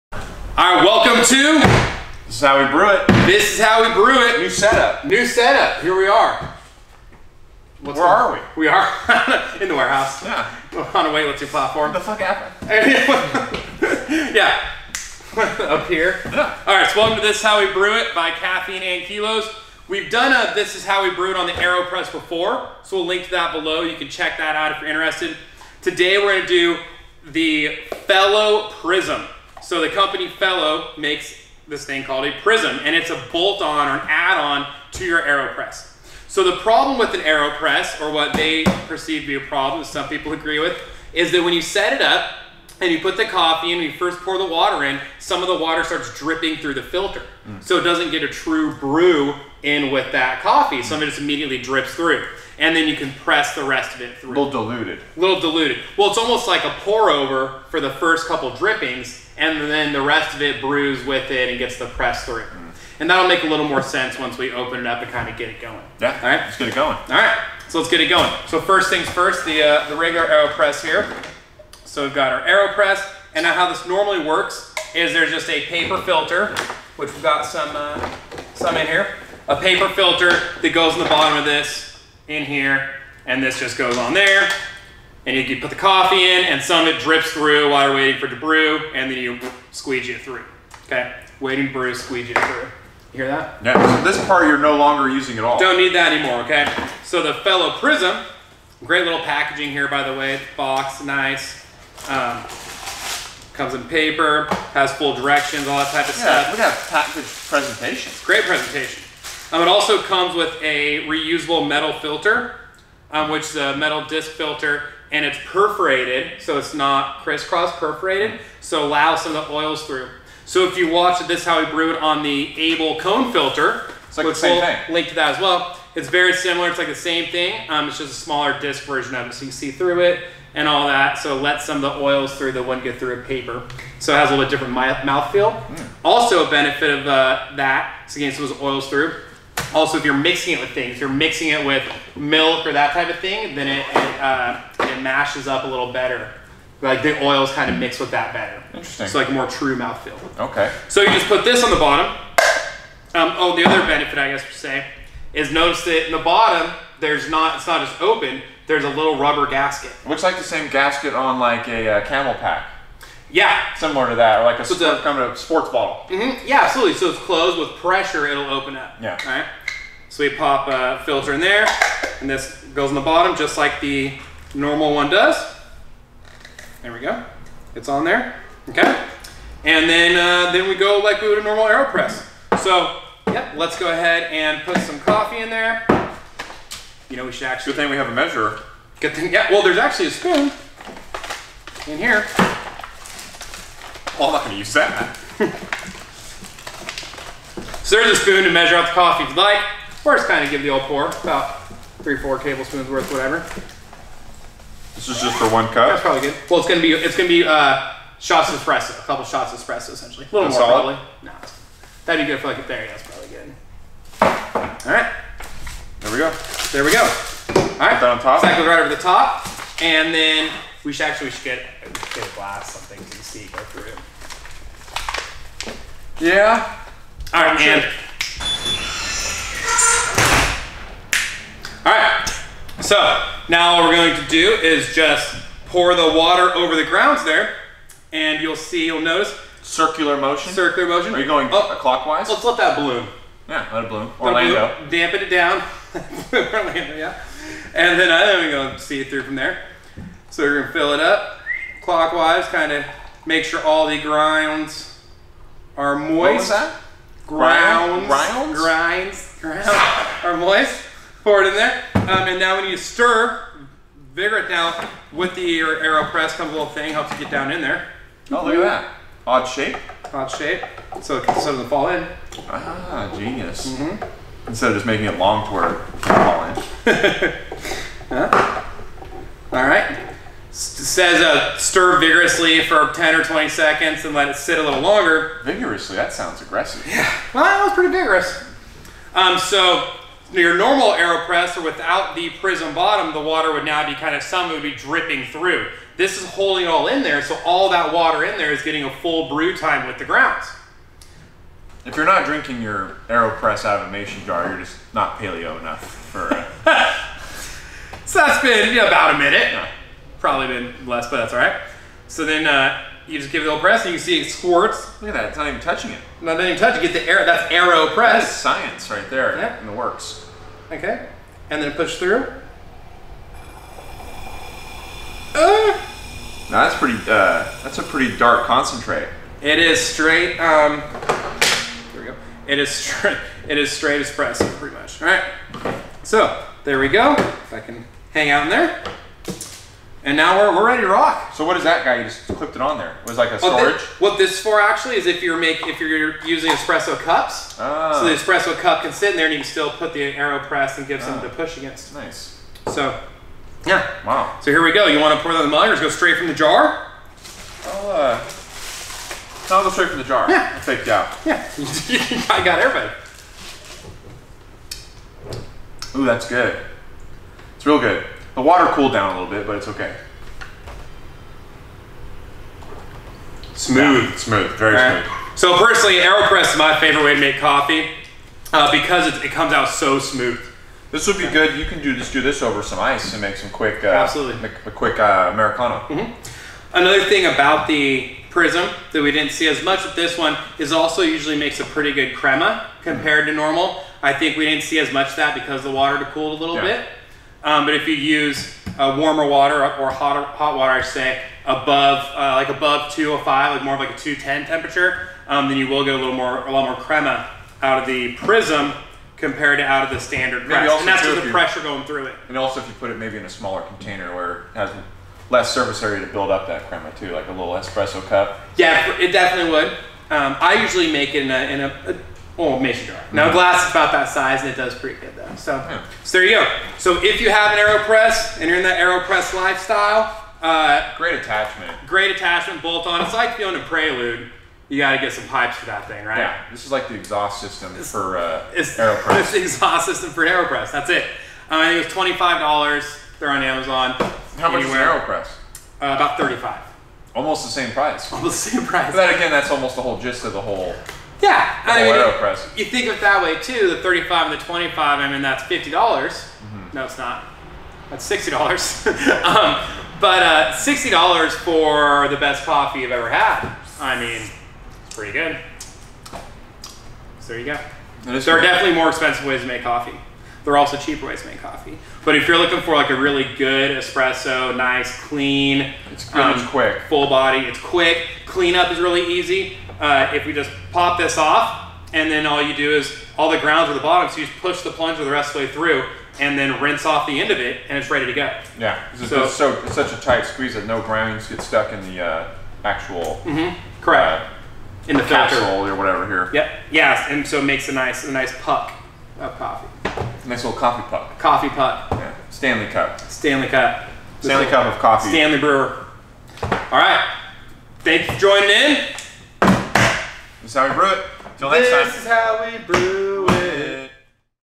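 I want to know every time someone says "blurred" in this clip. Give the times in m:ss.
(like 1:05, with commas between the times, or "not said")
not said.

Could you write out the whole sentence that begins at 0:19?
We've done a This Is How We Brew It on the AeroPress before, so we'll link to that below.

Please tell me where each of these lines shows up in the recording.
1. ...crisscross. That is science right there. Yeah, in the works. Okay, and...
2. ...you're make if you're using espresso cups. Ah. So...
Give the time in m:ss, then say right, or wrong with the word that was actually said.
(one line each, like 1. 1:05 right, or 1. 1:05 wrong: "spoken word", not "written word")
1. 5:17 wrong: "press", not "crisscross"
2. 5:45 right.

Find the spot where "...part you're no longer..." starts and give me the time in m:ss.
1:34.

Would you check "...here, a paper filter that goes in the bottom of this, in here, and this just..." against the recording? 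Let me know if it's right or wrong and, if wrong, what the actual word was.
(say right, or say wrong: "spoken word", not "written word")
right.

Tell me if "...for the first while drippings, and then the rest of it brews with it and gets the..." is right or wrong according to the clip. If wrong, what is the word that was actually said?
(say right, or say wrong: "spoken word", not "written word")
wrong: "couple", not "while".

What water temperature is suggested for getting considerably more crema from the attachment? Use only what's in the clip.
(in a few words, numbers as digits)
210.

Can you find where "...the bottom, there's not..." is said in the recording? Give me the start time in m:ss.
2:36.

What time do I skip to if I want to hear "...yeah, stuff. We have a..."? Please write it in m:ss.
1:46.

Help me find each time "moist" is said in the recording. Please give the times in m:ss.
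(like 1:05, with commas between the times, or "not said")
4:15, 4:20.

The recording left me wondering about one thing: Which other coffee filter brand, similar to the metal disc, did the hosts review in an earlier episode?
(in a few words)
Able Kone.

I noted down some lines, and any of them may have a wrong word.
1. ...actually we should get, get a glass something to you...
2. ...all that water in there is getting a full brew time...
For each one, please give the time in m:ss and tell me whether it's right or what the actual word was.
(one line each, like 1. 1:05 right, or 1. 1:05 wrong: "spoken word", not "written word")
1. 3:41 right
2. 4:57 right.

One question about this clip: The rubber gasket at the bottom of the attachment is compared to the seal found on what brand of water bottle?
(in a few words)
CamelBak.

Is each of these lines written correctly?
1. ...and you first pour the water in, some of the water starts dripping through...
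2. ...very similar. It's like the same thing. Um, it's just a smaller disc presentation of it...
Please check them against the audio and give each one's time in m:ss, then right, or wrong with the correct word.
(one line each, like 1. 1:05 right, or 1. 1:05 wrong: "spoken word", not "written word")
1. 0:43 right
2. 2:06 wrong: "version", not "presentation".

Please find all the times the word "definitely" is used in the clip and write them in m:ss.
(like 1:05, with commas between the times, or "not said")
6:59, 7:48.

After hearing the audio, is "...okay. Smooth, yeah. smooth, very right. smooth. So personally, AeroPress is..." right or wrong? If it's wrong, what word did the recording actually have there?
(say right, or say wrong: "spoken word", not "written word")
right.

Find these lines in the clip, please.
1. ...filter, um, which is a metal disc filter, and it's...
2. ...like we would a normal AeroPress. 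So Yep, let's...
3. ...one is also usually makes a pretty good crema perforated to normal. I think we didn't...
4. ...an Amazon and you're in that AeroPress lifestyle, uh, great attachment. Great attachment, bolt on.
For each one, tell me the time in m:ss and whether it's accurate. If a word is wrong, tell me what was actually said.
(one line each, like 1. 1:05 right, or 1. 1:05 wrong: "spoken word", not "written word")
1. 1:51 right
2. 3:01 right
3. 6:30 wrong: "compared", not "perforated"
4. 7:07 wrong: "AeroPress", not "Amazon".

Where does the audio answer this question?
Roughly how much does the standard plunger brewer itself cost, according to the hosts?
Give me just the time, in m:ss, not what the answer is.
7:26.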